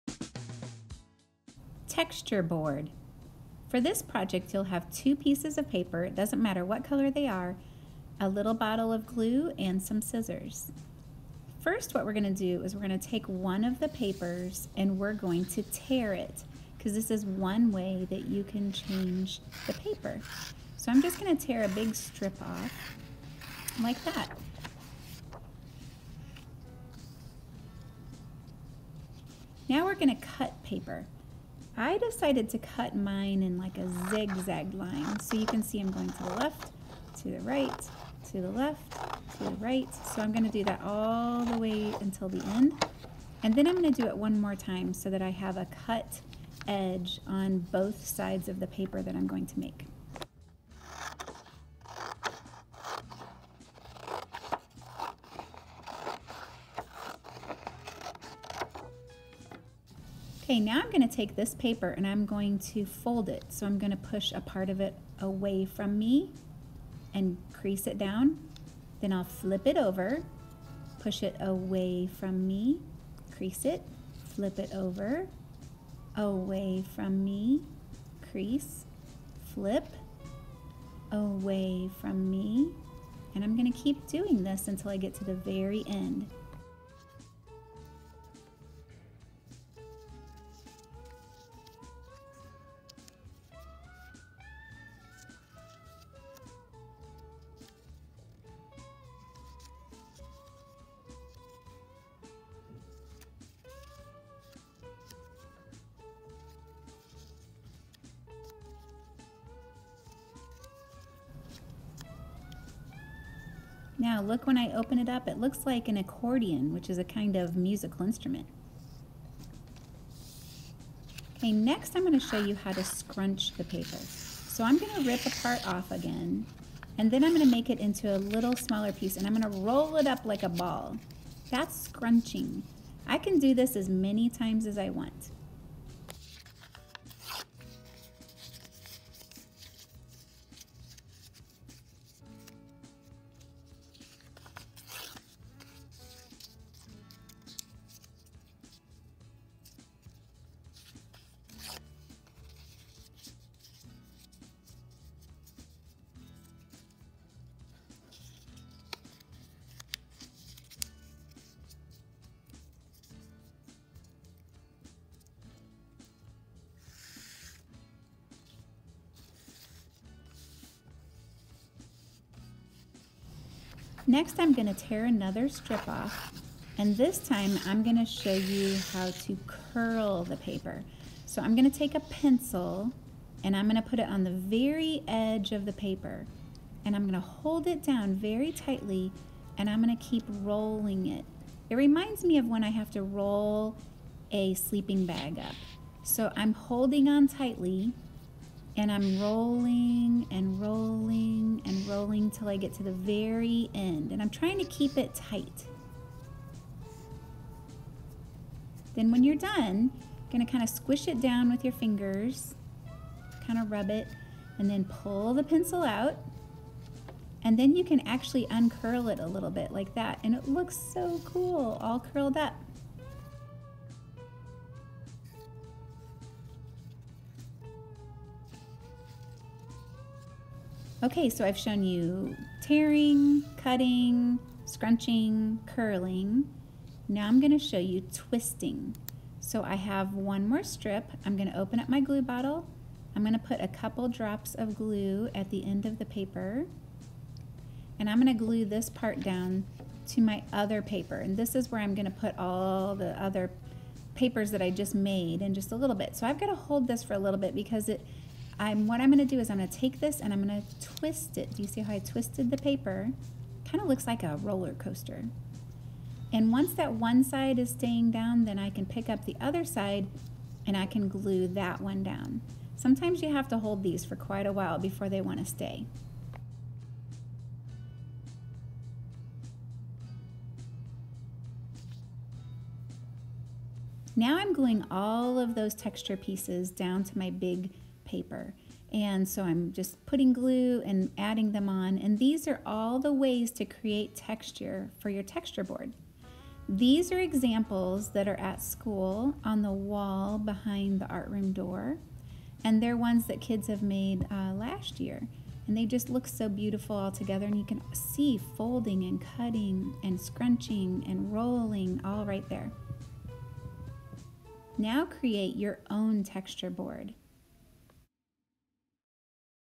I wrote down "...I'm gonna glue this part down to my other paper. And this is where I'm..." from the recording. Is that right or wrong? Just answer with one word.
right.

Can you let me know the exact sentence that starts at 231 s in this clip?
Okay, so I've shown you tearing, cutting, scrunching, curling.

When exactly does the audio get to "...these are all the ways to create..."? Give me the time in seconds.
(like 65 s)
292 s.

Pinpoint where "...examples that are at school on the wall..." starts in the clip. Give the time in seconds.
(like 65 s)
297 s.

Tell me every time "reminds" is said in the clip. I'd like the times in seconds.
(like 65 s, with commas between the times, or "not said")
191 s.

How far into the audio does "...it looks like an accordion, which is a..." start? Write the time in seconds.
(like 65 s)
115 s.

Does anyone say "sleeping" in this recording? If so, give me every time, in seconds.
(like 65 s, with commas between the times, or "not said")
194 s.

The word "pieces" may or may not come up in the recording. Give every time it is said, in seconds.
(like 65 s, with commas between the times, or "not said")
5 s, 128 s, 286 s.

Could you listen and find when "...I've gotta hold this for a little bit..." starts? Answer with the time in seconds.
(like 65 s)
256 s.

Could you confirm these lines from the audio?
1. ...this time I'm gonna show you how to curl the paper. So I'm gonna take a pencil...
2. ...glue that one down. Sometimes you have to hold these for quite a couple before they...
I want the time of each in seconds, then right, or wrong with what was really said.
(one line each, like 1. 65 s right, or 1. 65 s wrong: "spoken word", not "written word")
1. 176 s right
2. 271 s wrong: "while", not "couple".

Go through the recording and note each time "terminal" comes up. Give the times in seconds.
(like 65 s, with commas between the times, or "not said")
not said.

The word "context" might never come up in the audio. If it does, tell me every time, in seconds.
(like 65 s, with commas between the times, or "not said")
not said.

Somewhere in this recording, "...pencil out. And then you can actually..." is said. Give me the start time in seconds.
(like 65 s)
215 s.